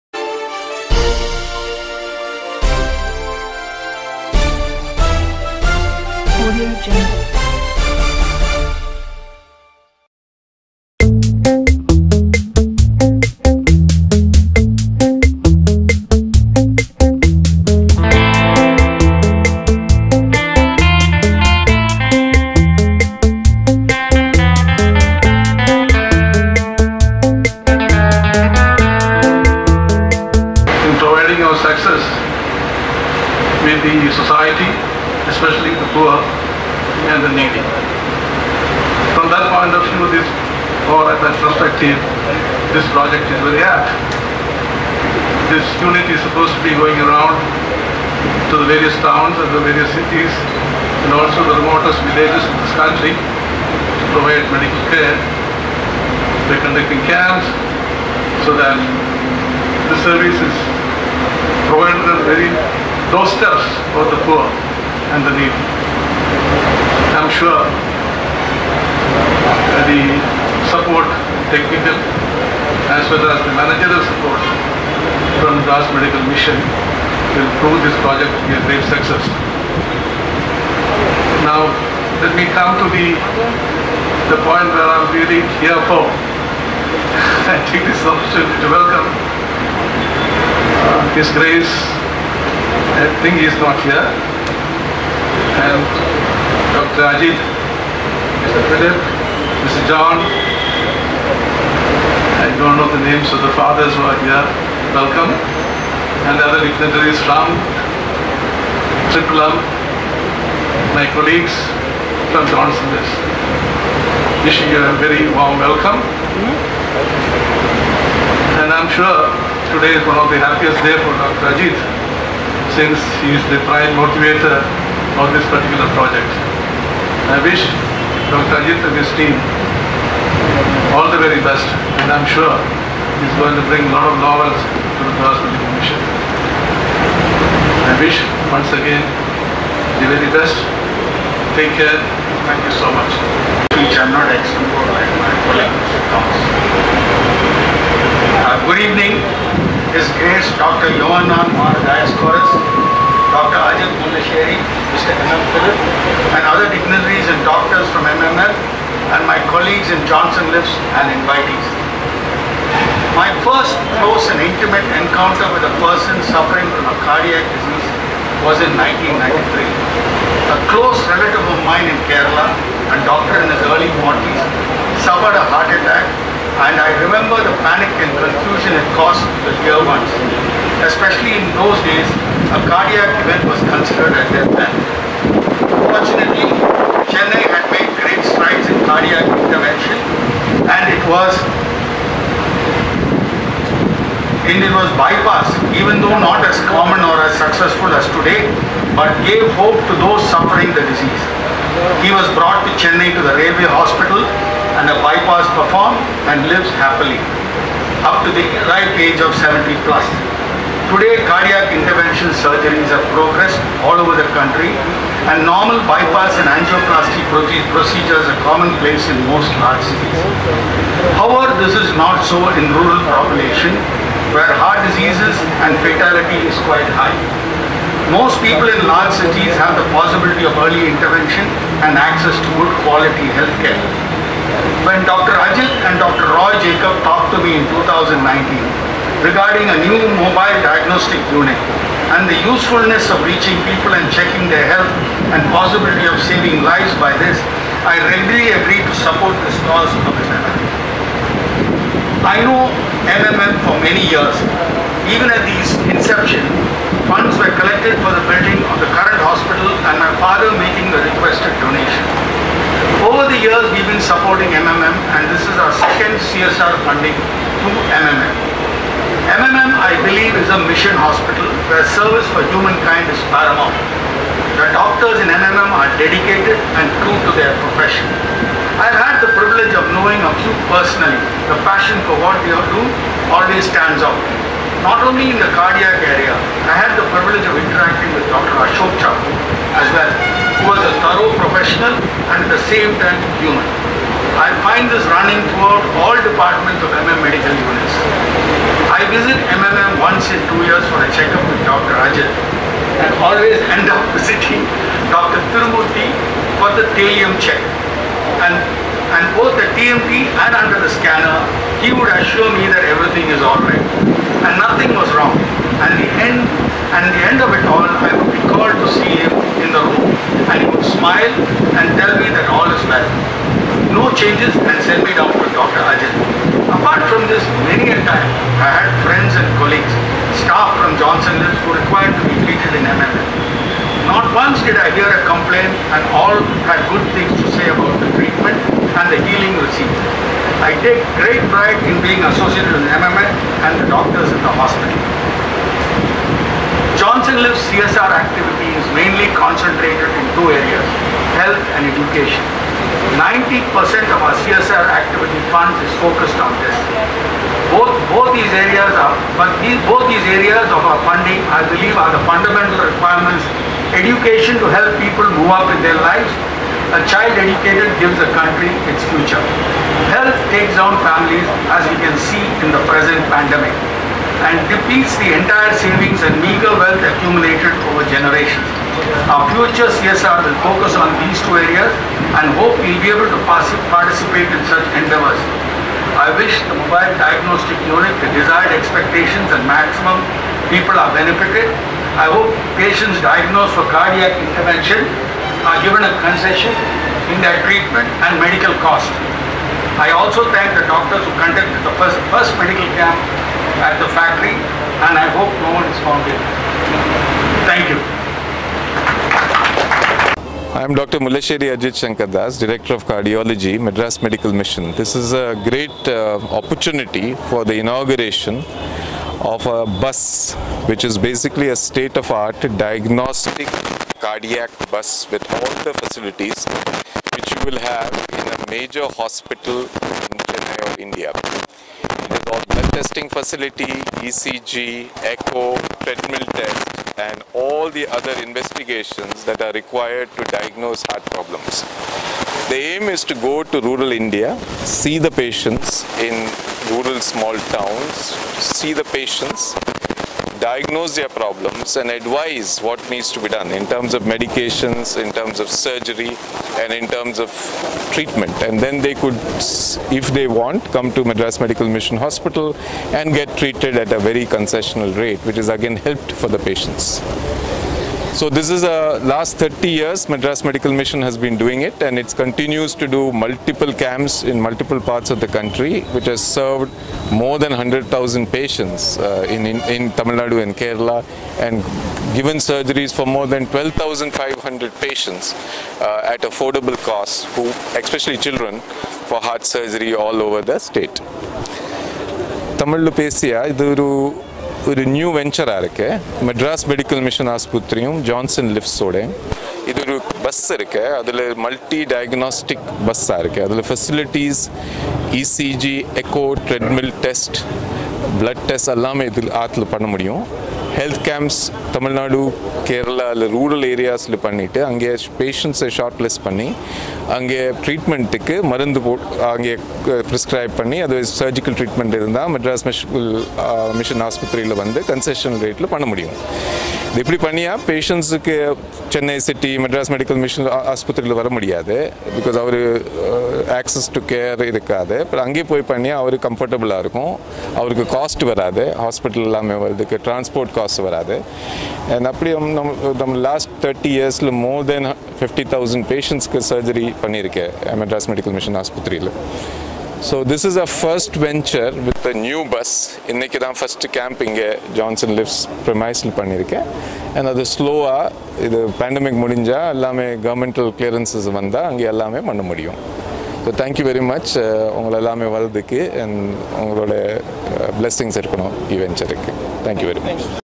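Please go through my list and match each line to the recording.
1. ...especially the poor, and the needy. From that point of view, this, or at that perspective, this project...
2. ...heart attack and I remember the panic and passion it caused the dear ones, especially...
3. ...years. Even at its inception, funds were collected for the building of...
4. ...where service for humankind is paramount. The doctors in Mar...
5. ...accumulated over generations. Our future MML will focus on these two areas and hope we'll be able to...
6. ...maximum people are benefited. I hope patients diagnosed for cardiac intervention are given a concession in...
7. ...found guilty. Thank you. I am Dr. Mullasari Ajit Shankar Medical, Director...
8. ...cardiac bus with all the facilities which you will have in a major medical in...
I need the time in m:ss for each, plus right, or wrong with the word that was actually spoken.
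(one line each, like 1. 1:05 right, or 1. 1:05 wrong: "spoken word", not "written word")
1. 0:35 right
2. 2:55 wrong: "confusion", not "passion"
3. 4:14 right
4. 4:31 wrong: "MMM", not "Mar"
5. 6:17 wrong: "CSR", not "MML"
6. 6:29 right
7. 6:46 wrong: "Das", not "Medical"
8. 7:04 wrong: "hospital", not "medical".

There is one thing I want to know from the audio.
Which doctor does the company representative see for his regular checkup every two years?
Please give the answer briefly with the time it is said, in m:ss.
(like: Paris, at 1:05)
Dr. Rajan, at 5:01.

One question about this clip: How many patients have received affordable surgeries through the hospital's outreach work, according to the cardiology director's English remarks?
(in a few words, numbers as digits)
12,500.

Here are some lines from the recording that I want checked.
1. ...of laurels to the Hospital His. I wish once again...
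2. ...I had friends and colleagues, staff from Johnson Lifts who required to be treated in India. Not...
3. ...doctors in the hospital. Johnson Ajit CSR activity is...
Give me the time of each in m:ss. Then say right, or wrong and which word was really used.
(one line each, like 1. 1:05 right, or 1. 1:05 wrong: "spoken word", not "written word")
1. 2:14 wrong: "Commission", not "His"
2. 5:28 wrong: "MML", not "India"
3. 5:43 wrong: "Lifts", not "Ajit".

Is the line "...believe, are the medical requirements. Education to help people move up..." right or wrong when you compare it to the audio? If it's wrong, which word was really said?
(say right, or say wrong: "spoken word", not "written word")
wrong: "fundamental", not "medical".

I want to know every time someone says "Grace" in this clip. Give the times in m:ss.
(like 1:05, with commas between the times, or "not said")
1:31, 2:30.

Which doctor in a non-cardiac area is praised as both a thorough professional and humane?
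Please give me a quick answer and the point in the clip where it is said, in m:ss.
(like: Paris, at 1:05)
Dr. Ashok Chacko, at 4:48.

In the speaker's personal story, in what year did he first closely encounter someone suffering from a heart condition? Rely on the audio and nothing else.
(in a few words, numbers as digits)
1993.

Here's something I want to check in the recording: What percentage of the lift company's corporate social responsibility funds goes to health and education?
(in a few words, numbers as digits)
90%.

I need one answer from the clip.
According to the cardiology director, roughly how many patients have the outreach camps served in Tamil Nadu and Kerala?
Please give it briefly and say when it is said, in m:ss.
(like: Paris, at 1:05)
100,000, at 7:57.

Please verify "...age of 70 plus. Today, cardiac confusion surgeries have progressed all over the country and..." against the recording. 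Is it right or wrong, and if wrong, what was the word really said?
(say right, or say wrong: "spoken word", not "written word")
wrong: "intervention", not "confusion".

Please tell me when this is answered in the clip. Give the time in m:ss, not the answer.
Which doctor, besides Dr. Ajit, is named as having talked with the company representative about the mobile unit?
3:56.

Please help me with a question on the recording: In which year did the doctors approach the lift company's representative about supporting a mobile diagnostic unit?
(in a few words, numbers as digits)
2019.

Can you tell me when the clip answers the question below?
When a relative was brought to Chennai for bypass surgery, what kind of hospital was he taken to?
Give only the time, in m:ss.
3:23.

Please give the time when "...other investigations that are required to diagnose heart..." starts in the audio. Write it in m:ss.
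7:18.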